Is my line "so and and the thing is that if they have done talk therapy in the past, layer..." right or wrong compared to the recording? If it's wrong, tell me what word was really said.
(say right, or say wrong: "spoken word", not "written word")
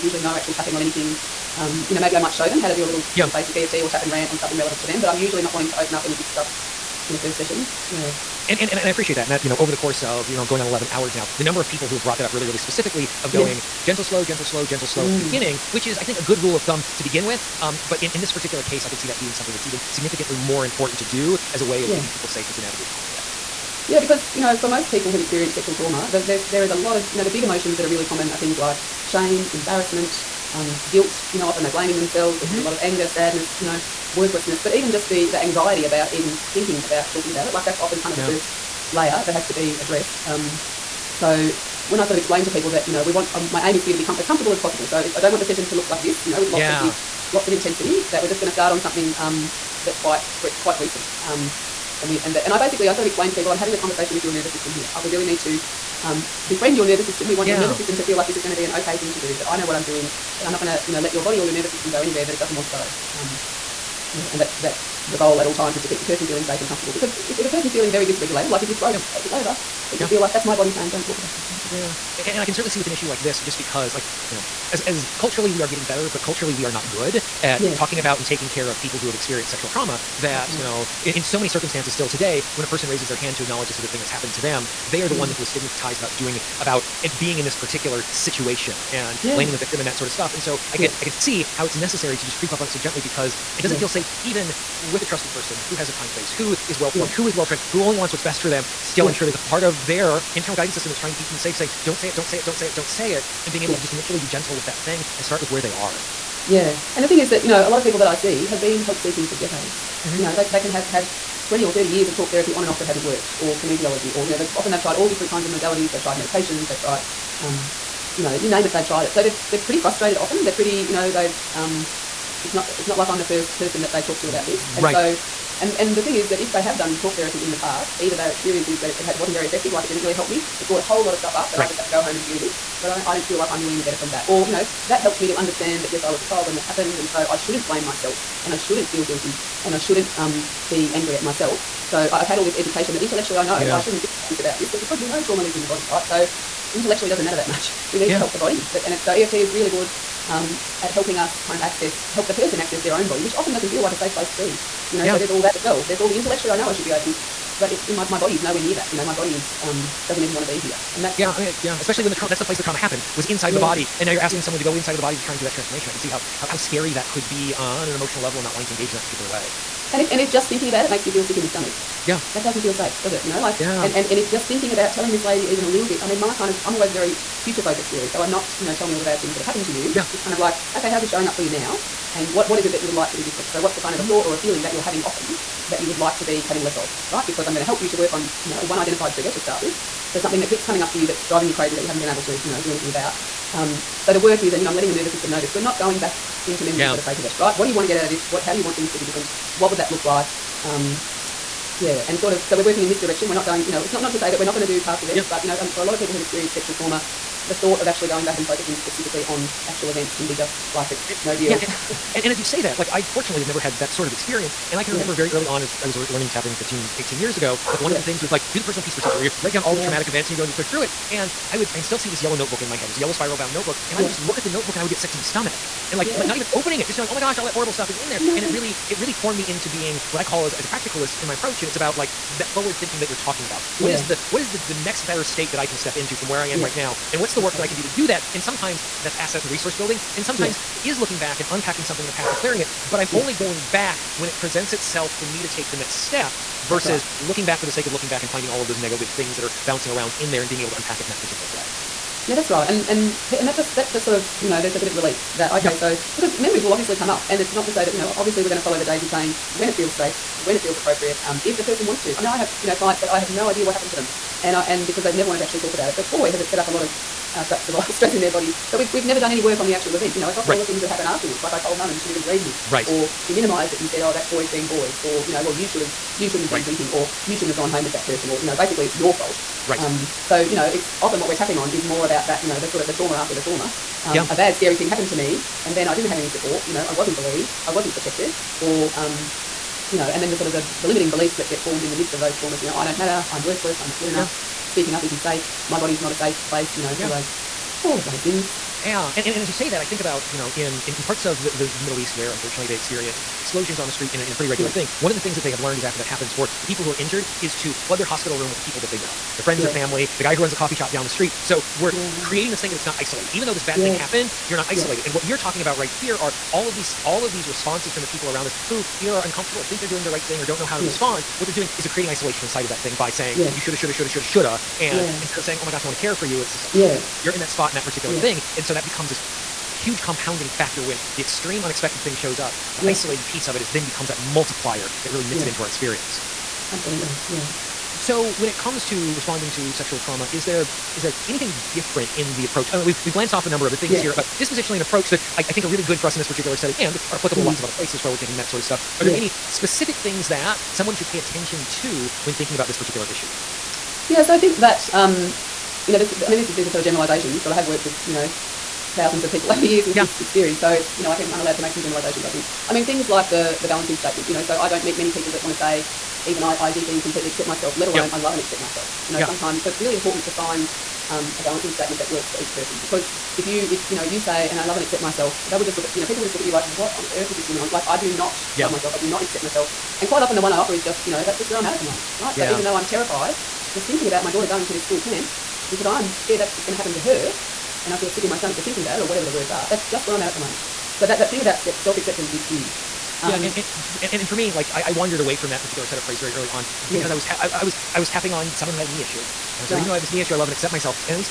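wrong: "either", not "layer".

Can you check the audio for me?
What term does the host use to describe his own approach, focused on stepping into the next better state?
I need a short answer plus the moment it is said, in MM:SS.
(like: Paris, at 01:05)
Practicalist, at 03:50.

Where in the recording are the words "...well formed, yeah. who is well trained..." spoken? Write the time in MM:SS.
01:36.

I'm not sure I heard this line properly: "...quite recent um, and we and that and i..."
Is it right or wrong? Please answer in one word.
right.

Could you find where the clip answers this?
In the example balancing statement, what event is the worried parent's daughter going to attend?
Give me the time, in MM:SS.
06:24.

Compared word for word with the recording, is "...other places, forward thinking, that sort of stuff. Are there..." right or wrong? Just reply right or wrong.
right.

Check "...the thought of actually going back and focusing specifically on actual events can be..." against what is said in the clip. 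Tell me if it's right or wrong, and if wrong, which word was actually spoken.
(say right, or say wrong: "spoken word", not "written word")
right.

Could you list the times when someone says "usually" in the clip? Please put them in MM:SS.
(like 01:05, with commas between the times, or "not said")
00:00, 00:05.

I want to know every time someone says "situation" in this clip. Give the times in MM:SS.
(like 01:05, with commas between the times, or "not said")
01:28.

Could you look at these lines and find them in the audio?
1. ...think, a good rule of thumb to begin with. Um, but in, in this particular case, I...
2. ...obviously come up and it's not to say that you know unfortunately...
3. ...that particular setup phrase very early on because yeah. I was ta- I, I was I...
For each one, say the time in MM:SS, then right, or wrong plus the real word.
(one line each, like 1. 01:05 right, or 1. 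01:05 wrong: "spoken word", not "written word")
1. 00:16 right
2. 04:16 wrong: "obviously", not "unfortunately"
3. 06:35 right.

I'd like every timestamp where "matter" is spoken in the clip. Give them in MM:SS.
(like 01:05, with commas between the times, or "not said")
02:27, 04:52.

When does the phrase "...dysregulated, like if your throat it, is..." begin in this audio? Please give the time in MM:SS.
01:08.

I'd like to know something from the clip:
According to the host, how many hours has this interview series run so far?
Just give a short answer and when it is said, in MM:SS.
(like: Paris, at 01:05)
11 hours, at 00:10.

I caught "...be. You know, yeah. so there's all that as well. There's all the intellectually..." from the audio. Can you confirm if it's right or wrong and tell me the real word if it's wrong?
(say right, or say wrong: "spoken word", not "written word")
right.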